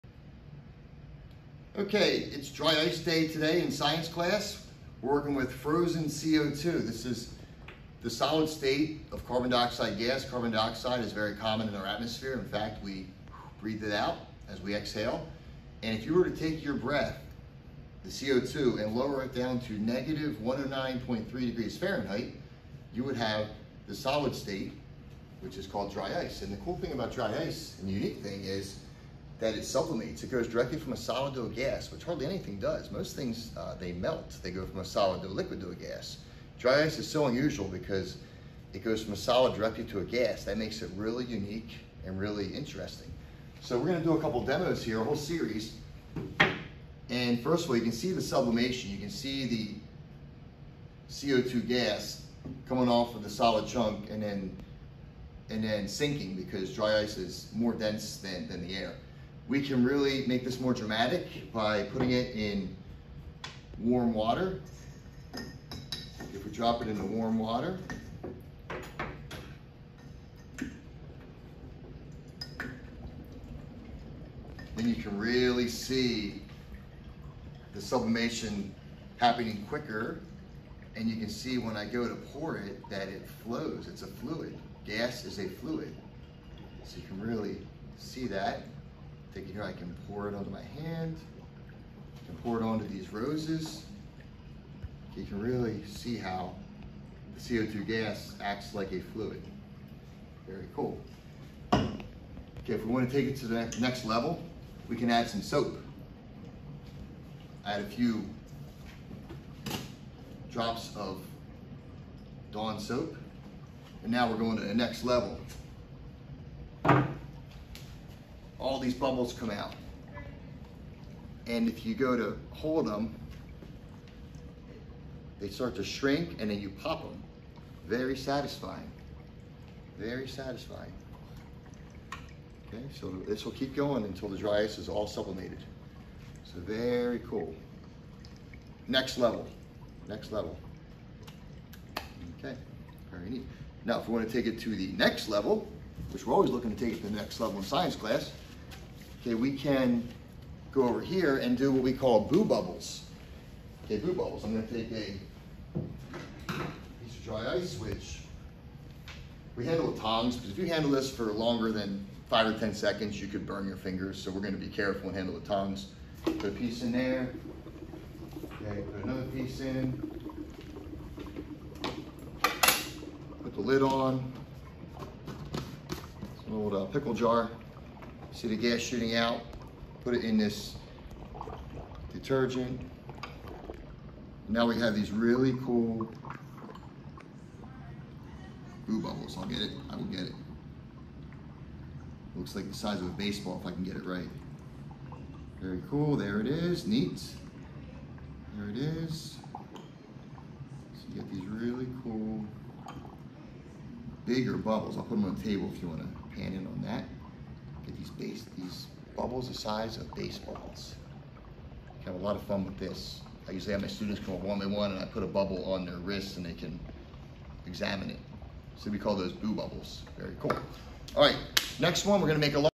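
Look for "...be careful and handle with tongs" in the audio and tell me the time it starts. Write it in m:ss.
2:44.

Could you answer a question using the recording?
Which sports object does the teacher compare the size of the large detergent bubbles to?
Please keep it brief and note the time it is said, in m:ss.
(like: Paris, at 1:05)
Baseball, at 3:13.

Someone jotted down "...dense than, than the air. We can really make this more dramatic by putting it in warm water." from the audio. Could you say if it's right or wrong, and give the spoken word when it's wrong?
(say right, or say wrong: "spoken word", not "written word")
right.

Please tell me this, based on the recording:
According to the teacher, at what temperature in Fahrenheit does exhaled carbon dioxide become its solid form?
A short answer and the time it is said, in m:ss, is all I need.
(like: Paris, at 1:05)
-109.3 degrees Fahrenheit, at 0:19.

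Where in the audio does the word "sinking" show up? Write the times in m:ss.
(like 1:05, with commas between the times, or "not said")
0:55.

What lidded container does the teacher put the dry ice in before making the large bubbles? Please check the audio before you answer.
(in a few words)
Pickle jar.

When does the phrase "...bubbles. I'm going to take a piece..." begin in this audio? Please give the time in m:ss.
2:34.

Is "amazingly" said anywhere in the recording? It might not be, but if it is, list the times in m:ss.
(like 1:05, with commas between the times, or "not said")
not said.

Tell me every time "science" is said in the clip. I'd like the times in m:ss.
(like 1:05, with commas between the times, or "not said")
0:03, 2:27.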